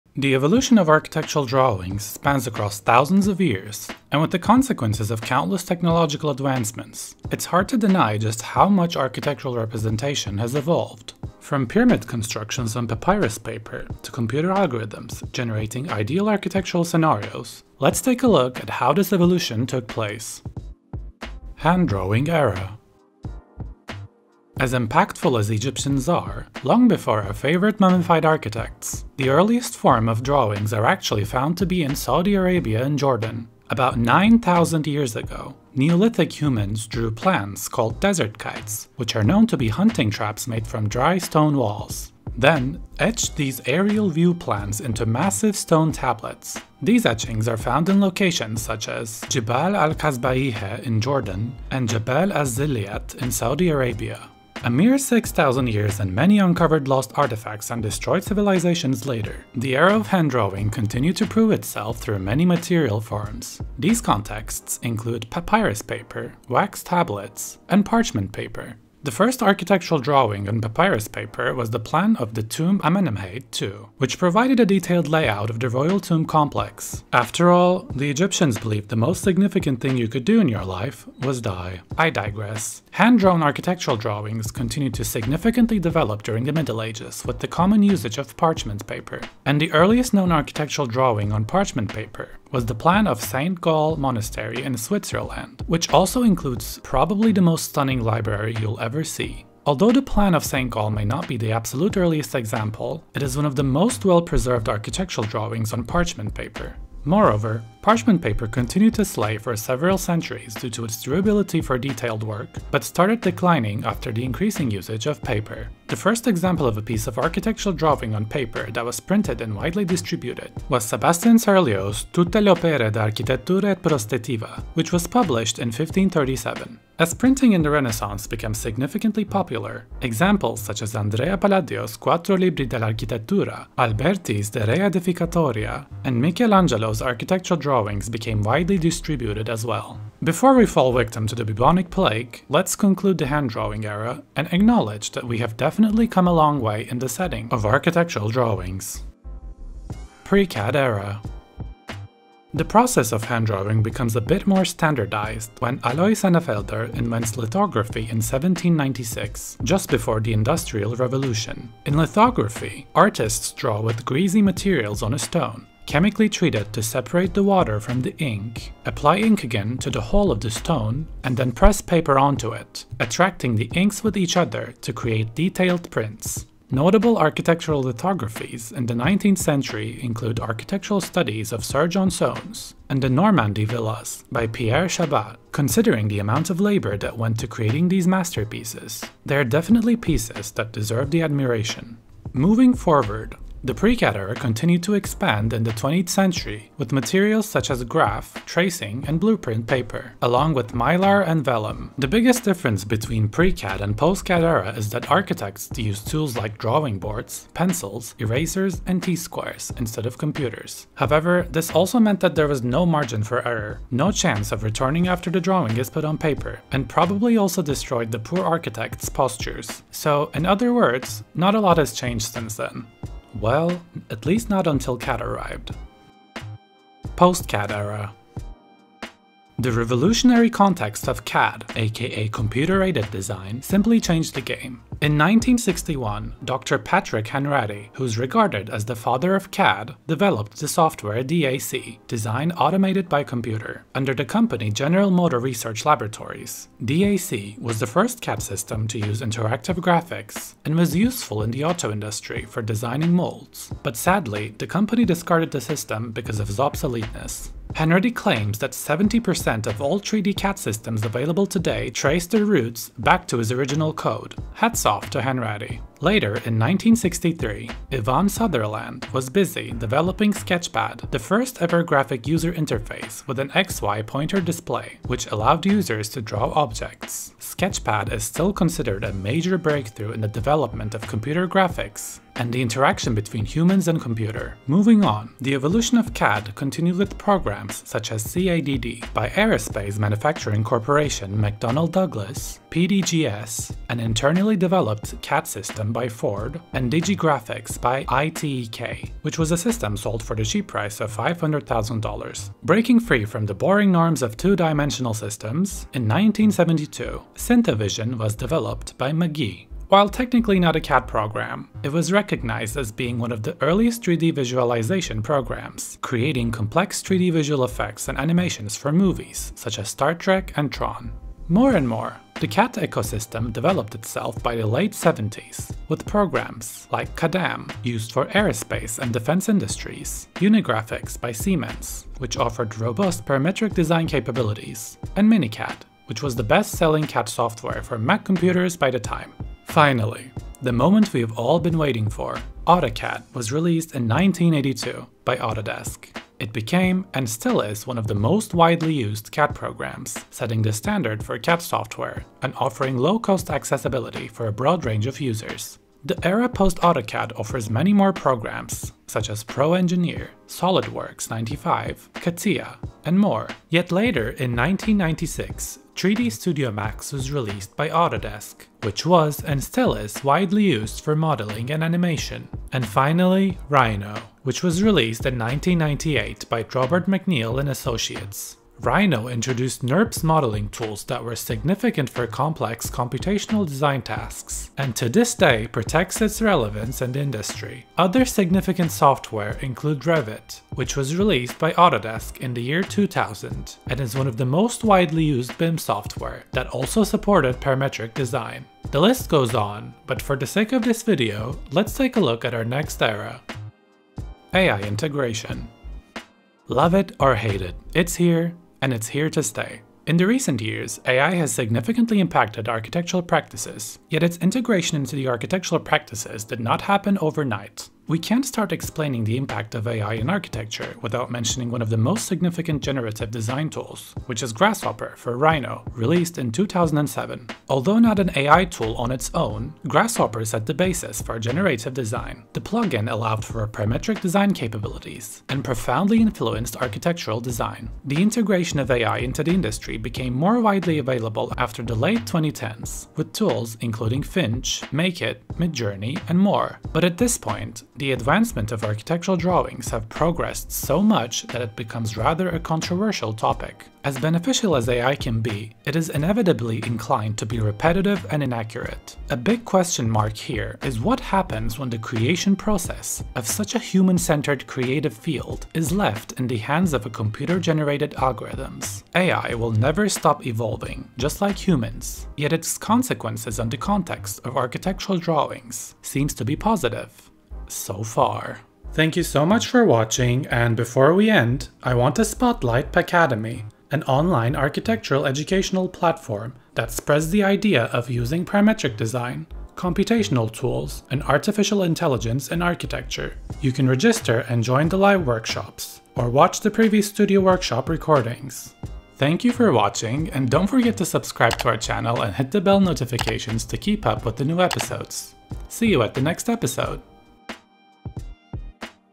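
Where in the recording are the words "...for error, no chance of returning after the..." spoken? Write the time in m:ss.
3:33.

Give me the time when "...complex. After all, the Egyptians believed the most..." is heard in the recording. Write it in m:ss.
1:16.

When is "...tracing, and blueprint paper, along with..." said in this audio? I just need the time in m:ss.
3:18.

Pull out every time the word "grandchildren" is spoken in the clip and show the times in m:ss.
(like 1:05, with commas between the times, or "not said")
not said.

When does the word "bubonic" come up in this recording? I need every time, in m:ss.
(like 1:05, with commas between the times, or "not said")
2:21.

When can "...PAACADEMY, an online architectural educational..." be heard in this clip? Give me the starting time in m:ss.
8:02.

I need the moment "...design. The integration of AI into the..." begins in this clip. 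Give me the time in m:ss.
7:17.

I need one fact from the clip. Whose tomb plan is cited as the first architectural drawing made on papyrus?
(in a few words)
Amenemhate II.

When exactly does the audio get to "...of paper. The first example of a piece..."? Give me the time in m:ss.
1:55.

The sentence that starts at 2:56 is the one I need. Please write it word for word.
Notable architectural lithographies in the 19th century include architectural studies of Sir John Soane's and the Normandy villas by Pierre Chabat.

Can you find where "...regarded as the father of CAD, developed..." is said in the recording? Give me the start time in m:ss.
3:58.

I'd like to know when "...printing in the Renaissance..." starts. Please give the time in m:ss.
2:07.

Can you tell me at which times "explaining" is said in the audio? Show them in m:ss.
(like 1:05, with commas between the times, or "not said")
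6:58.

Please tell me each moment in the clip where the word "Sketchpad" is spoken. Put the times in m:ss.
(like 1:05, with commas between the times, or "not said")
4:30, 4:37.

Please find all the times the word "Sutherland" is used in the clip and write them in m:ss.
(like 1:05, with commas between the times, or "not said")
4:28.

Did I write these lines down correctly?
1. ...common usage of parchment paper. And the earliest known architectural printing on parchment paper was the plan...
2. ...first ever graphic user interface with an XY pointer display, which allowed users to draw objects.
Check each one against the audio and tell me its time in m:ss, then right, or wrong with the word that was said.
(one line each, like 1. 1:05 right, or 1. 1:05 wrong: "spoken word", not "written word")
1. 1:27 wrong: "drawing", not "printing"
2. 4:31 right.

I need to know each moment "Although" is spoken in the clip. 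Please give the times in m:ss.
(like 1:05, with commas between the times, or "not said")
1:39, 7:07.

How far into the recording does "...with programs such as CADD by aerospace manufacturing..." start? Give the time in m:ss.
4:46.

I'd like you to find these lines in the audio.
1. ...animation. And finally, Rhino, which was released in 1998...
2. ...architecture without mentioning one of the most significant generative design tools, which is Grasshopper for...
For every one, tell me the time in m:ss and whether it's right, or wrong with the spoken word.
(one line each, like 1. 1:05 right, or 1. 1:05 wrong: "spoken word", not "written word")
1. 6:11 right
2. 7:00 right.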